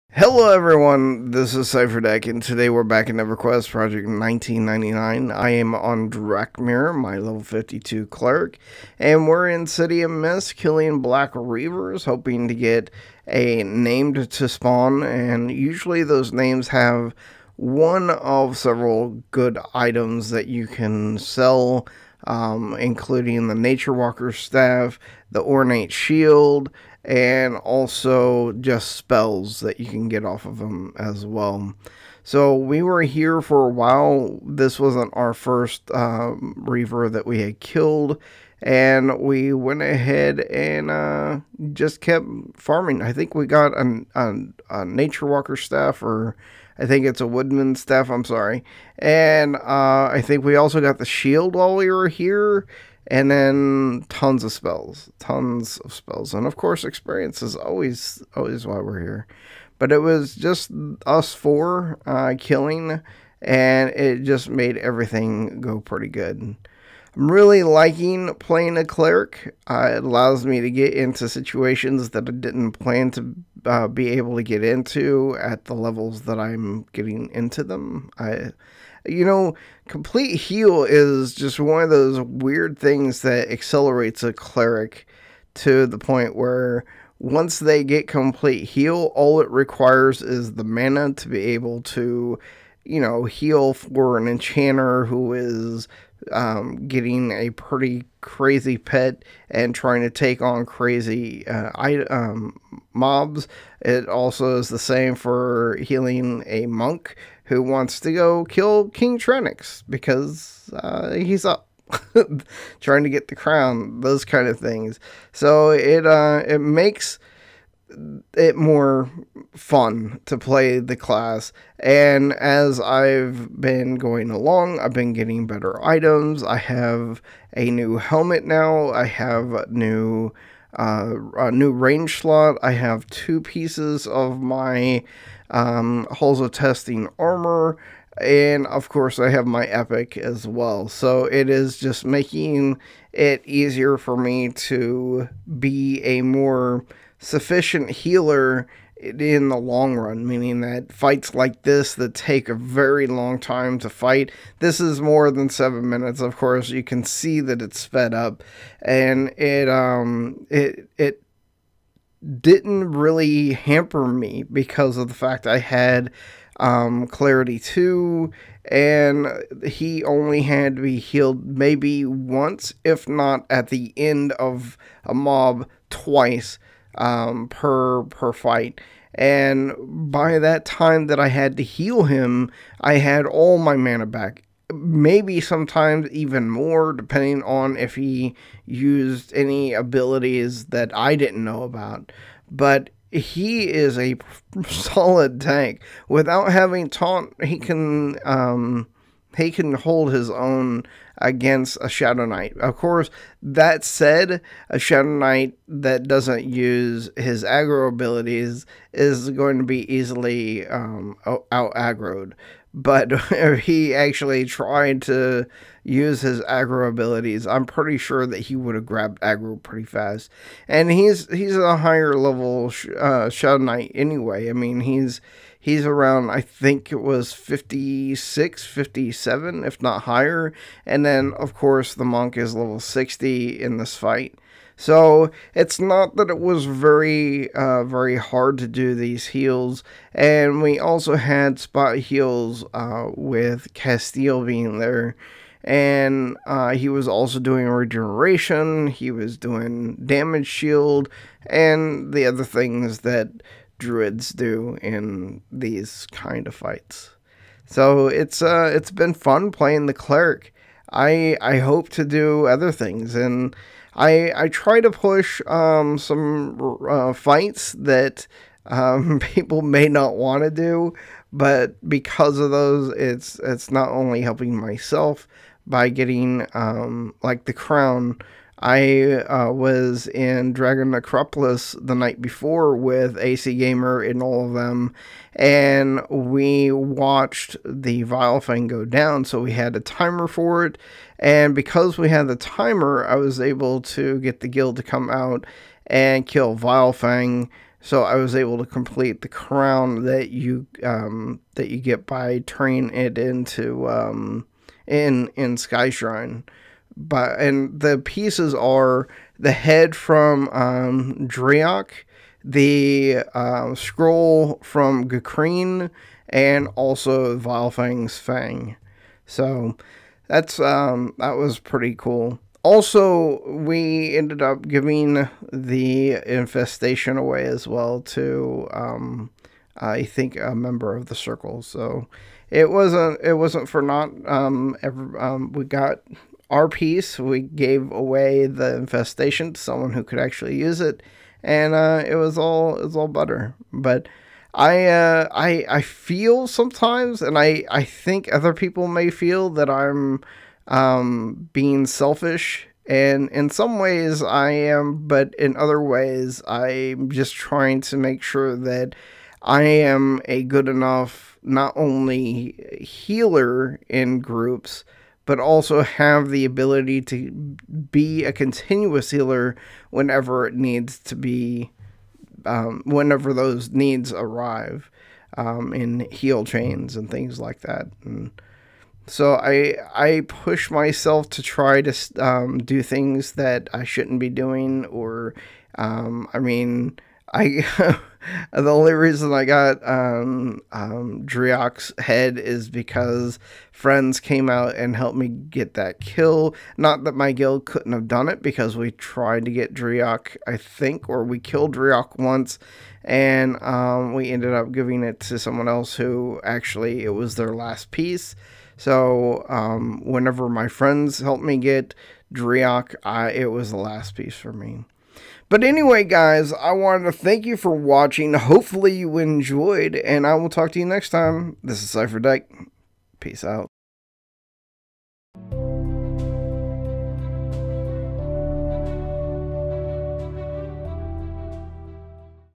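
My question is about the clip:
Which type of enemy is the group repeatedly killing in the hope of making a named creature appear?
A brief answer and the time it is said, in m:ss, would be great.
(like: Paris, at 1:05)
Black Reavers, at 0:11.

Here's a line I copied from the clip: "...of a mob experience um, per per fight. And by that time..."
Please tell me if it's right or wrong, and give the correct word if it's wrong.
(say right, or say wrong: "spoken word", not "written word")
wrong: "twice", not "experience".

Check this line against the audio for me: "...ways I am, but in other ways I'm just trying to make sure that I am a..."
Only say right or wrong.
right.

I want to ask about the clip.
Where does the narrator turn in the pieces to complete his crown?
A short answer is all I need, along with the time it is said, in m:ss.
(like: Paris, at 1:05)
Sky Shrine, at 5:05.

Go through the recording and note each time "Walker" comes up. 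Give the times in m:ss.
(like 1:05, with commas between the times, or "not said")
0:23, 0:45.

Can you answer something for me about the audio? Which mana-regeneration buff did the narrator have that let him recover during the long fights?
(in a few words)
Clarity 2.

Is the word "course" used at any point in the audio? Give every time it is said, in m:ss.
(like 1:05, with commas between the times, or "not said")
0:56, 2:18, 2:36, 3:22, 3:51.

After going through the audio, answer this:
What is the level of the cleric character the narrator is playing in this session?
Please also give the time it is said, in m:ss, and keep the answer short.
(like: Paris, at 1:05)
52, at 0:07.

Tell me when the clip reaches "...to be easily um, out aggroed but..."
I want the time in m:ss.
3:29.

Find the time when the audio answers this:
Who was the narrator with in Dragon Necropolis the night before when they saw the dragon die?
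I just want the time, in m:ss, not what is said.
4:43.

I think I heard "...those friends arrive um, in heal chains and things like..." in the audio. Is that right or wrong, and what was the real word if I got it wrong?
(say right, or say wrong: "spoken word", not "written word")
wrong: "needs", not "friends".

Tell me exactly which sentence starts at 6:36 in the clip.
Not that my guild couldn't have done it because we tried to get Driok.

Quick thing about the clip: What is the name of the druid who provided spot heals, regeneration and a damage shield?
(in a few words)
Castile.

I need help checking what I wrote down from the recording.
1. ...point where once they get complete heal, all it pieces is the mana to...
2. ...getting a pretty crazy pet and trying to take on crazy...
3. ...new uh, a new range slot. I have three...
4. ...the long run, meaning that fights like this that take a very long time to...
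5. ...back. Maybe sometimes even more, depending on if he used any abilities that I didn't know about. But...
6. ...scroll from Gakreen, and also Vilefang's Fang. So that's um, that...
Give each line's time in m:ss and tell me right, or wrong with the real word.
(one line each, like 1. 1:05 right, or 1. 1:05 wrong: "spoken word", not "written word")
1. 1:25 wrong: "requires", not "pieces"
2. 1:36 right
3. 2:09 wrong: "two", not "three"
4. 2:29 right
5. 3:04 right
6. 5:13 right.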